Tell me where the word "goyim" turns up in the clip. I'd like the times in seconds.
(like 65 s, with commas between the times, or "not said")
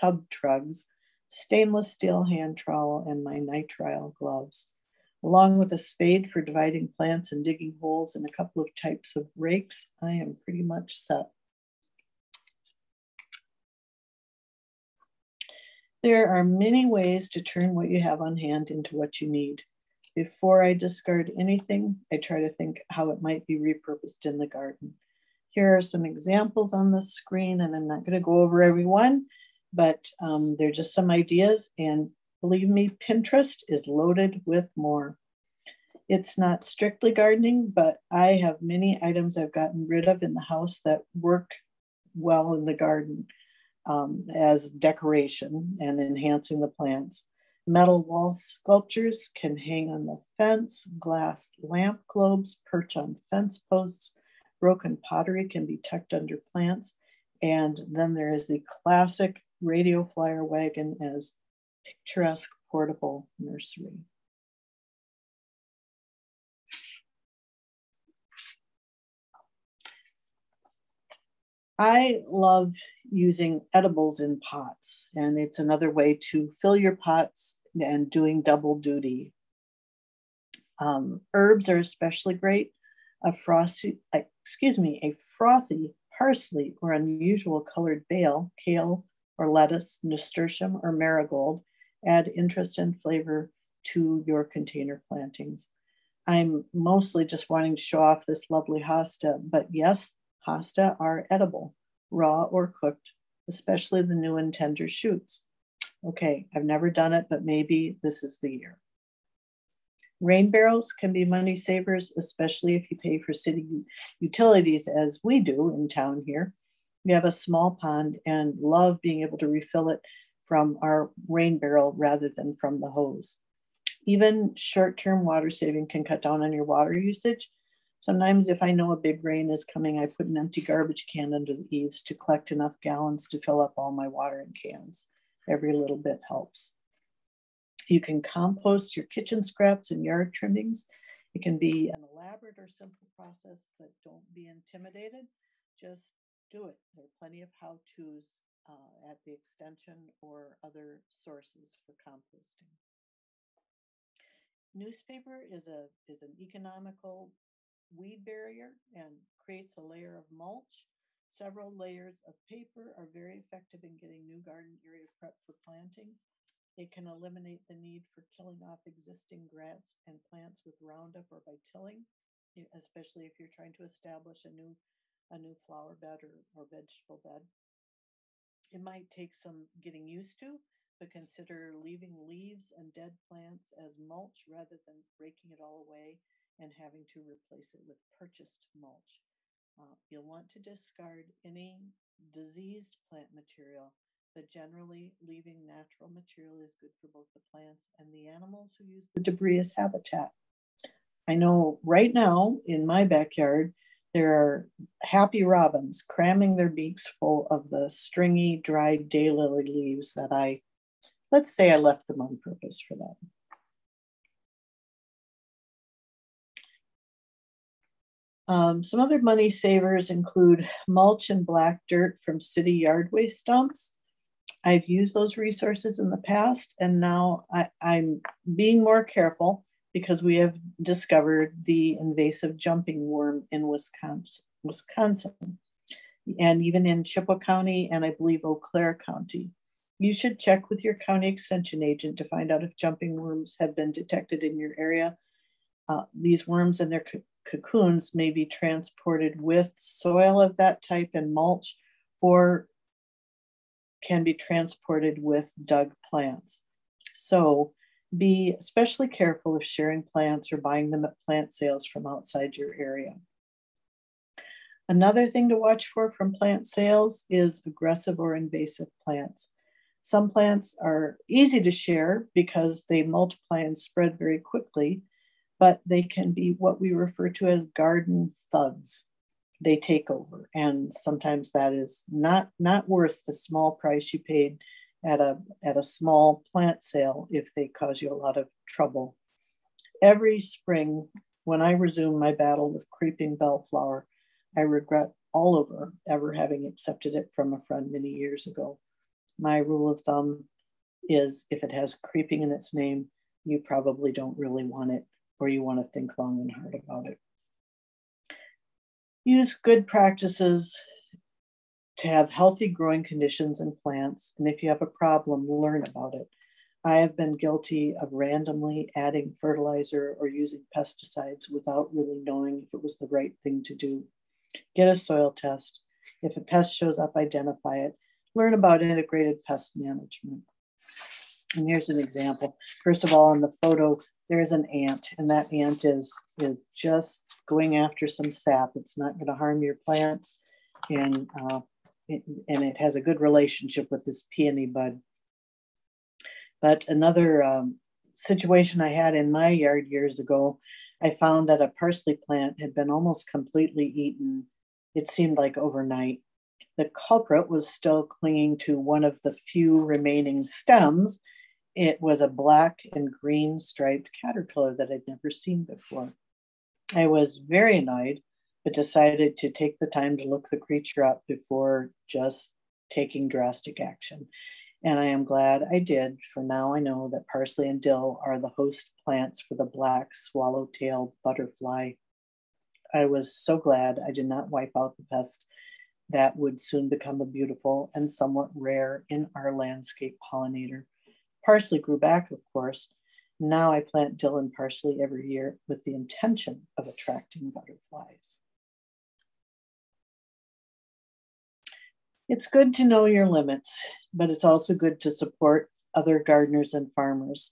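not said.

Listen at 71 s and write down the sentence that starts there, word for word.
I love using edibles in pots, and it's another way to fill your pots and doing double duty.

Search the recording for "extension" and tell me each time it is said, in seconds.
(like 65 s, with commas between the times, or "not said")
149 s, 241 s.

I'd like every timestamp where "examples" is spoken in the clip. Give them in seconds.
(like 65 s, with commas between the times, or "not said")
26 s, 331 s.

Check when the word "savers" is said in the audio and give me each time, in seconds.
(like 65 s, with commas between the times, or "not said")
111 s, 219 s.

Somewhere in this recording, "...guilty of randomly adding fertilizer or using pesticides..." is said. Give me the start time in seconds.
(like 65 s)
317 s.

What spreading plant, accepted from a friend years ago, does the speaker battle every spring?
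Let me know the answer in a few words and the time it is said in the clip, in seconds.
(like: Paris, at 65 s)
creeping bellflower, at 292 s.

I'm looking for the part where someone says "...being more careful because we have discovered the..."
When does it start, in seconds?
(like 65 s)
228 s.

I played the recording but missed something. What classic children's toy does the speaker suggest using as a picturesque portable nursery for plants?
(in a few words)
Radio Flyer wagon.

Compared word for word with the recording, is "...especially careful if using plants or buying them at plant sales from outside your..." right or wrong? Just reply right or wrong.
wrong.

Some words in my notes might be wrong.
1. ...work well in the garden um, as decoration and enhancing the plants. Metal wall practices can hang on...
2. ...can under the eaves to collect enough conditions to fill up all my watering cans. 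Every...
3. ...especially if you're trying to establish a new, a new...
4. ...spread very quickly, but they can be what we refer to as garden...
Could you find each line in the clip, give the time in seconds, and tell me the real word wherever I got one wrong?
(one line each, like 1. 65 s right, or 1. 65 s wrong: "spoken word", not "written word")
1. 41 s wrong: "sculptures", not "practices"
2. 131 s wrong: "gallons", not "conditions"
3. 172 s right
4. 273 s right.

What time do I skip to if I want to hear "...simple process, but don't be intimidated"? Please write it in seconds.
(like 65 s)
142 s.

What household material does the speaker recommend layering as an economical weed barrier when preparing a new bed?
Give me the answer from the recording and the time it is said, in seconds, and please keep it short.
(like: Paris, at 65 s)
Newspaper, at 154 s.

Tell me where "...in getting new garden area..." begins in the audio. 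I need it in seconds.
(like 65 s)
163 s.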